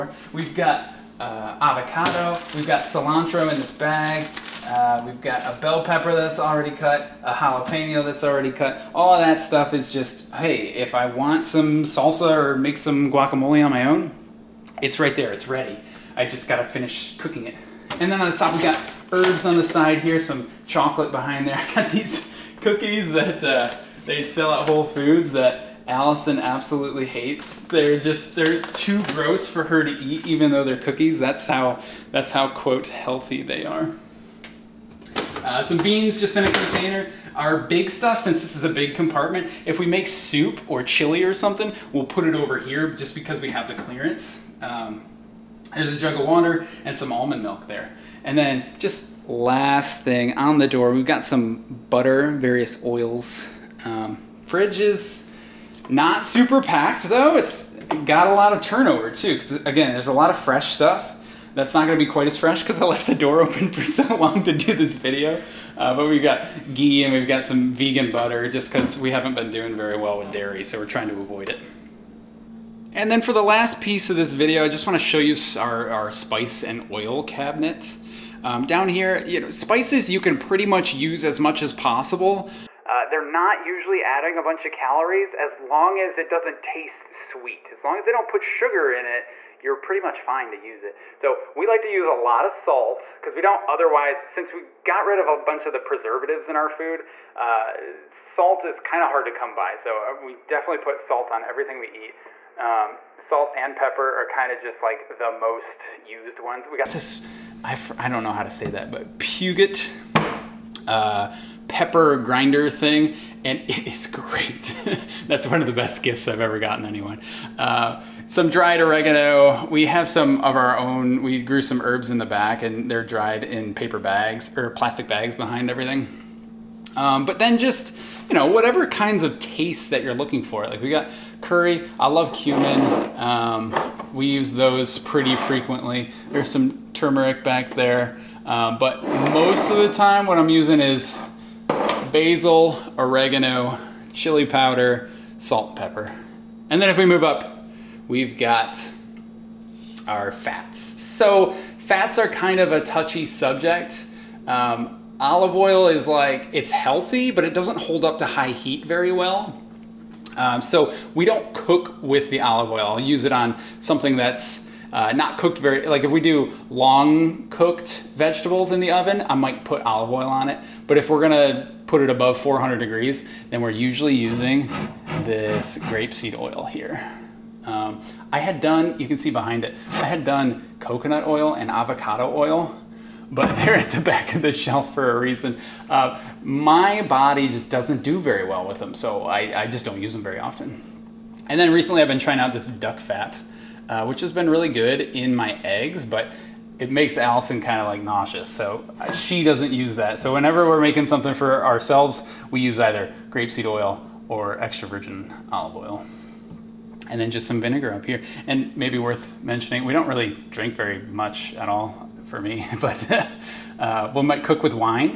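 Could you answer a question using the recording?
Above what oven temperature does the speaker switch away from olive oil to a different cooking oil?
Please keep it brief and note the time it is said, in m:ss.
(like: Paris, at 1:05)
400 degrees, at 2:52.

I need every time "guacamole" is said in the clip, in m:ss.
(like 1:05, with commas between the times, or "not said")
0:13.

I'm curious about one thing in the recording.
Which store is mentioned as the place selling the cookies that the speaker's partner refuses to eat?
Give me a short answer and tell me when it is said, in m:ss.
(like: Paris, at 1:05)
Whole Foods, at 0:24.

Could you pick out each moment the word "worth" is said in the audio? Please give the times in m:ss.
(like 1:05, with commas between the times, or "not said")
3:28.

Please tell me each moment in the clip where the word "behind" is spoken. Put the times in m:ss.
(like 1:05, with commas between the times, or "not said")
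0:21, 2:05, 2:59.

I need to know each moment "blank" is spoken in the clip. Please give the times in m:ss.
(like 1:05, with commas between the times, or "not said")
not said.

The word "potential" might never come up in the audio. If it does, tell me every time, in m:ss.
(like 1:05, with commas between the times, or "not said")
not said.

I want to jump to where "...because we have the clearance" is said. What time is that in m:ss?
0:43.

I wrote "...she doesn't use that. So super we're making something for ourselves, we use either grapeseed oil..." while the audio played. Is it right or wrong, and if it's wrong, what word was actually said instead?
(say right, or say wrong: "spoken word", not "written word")
wrong: "whenever", not "super".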